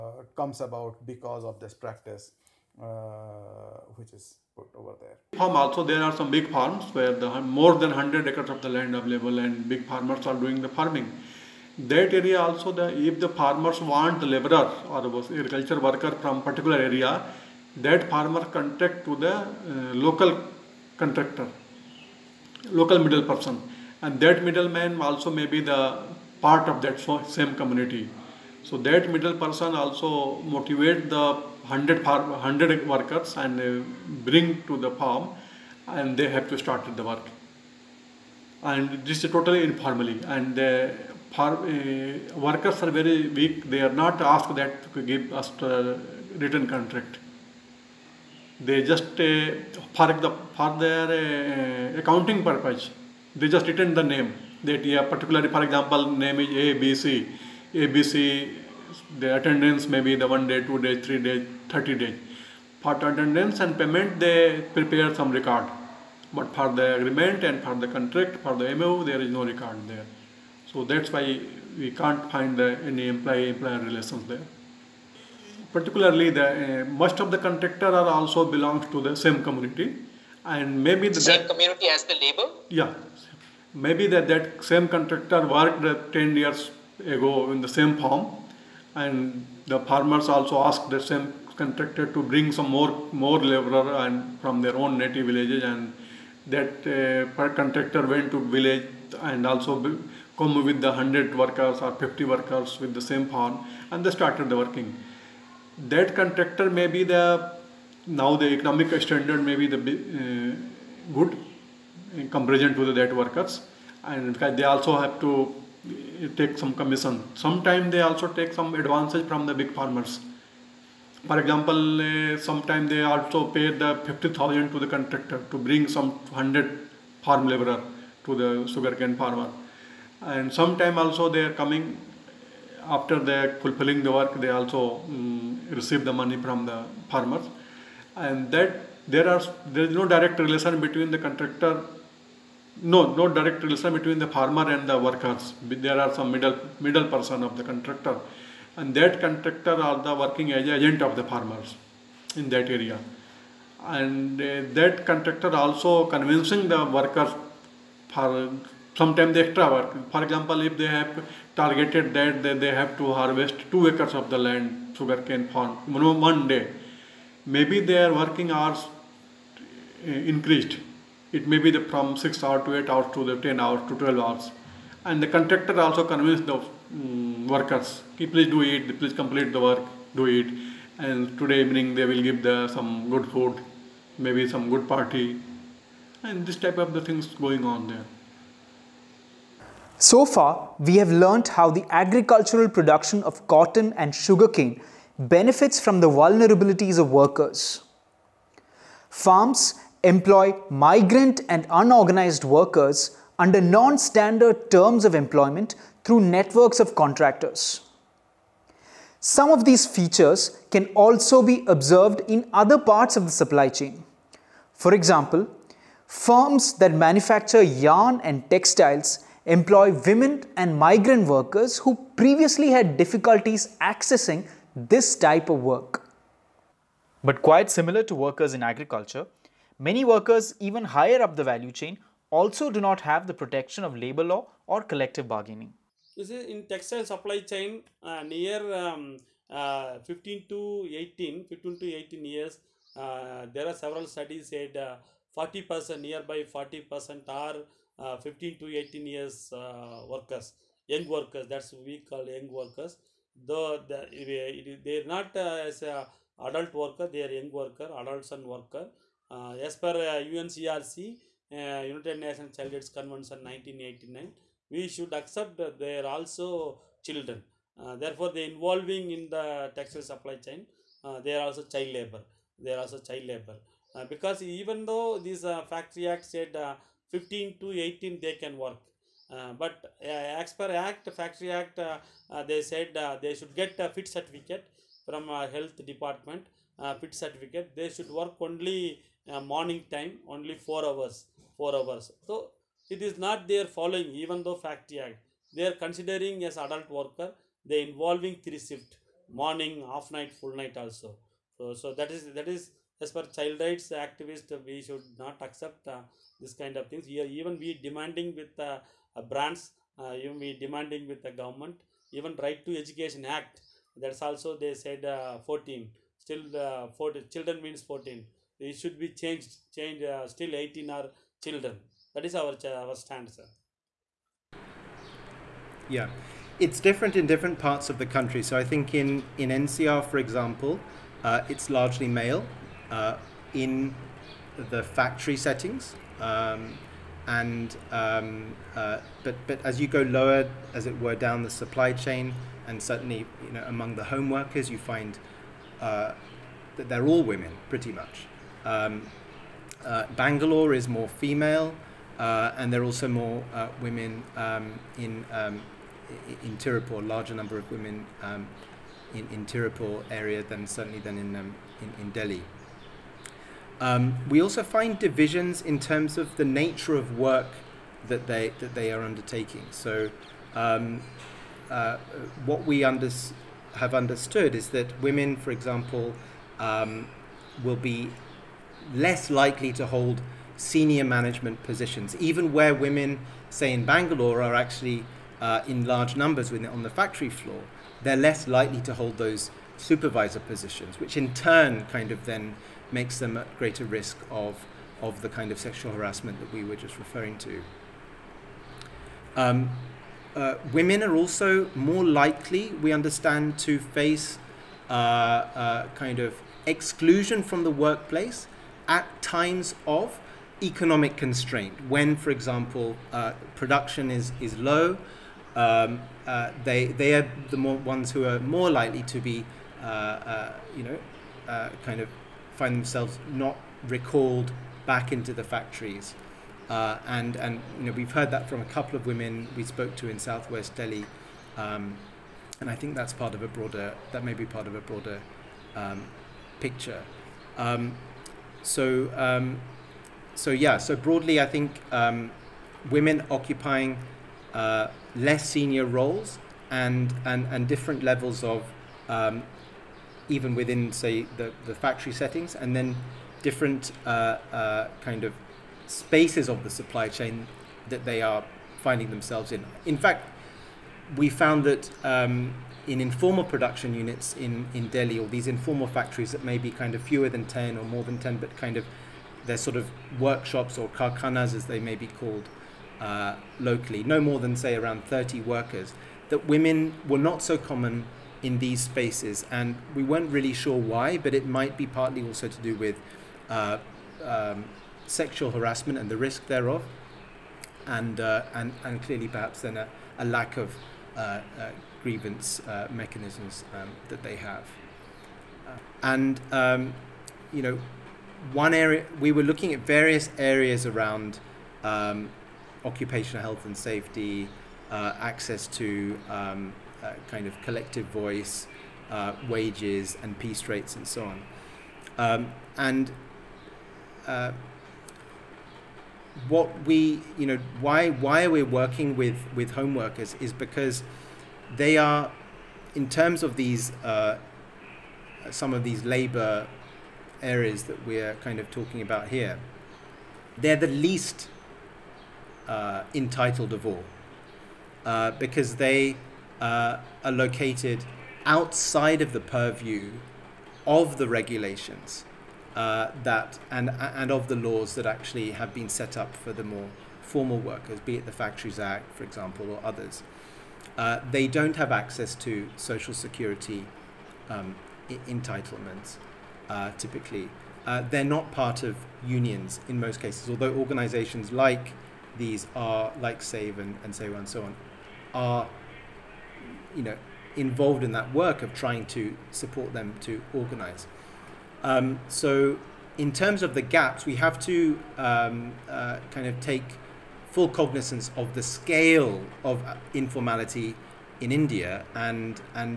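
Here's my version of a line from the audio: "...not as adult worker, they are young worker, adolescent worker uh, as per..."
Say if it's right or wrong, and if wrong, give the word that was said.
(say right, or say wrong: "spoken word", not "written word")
right.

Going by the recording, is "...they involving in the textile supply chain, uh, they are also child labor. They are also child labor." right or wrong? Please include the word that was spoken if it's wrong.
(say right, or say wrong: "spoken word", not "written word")
right.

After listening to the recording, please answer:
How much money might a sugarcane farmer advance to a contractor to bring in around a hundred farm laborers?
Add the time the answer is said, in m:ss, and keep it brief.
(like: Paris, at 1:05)
50,000, at 2:04.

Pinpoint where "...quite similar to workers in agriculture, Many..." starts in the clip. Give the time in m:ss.
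3:47.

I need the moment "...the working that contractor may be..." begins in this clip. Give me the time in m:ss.
1:44.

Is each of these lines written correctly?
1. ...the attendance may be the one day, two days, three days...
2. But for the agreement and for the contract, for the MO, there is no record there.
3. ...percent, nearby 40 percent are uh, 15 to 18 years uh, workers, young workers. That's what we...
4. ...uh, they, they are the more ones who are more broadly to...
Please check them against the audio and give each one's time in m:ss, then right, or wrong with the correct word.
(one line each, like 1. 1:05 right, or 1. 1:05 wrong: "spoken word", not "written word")
1. 0:59 right
2. 1:06 right
3. 4:05 right
4. 6:56 wrong: "likely", not "broadly".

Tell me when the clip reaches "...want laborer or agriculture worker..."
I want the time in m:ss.
0:13.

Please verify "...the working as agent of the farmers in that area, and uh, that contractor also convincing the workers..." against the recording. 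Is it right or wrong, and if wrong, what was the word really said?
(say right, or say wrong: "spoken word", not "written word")
right.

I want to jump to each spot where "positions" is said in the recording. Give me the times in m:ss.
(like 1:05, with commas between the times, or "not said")
6:21, 6:30.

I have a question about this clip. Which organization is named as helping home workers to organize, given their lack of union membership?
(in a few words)
SAVE.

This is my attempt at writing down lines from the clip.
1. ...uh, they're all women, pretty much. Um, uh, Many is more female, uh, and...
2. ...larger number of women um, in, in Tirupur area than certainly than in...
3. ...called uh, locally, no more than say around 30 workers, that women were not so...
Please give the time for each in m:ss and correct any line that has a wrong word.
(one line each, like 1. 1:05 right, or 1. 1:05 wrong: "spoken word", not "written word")
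1. 5:45 wrong: "Bangalore", not "Many"
2. 5:57 right
3. 7:52 right.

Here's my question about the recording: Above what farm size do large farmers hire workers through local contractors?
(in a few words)
100 acres.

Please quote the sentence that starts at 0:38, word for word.
And this is totally informally and the farm, uh, workers are very weak.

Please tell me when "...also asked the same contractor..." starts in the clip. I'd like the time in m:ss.
1:30.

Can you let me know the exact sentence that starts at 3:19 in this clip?
Farms employ migrant and unorganized workers under non-standard terms of employment through networks of contractors.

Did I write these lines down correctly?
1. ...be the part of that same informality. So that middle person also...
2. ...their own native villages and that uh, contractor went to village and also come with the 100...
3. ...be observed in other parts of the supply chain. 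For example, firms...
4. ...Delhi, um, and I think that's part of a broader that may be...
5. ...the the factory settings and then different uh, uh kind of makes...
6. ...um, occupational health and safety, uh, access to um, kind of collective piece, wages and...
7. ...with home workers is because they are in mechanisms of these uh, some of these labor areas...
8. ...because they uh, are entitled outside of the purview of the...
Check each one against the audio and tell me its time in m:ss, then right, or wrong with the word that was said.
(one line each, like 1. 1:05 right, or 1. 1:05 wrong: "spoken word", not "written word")
1. 0:25 wrong: "community", not "informality"
2. 1:34 right
3. 3:31 right
4. 7:10 right
5. 7:31 wrong: "spaces", not "makes"
6. 8:21 wrong: "voice", not "piece"
7. 8:39 wrong: "terms", not "mechanisms"
8. 8:55 wrong: "located", not "entitled".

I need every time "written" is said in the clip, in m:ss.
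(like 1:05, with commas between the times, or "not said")
0:46, 0:53.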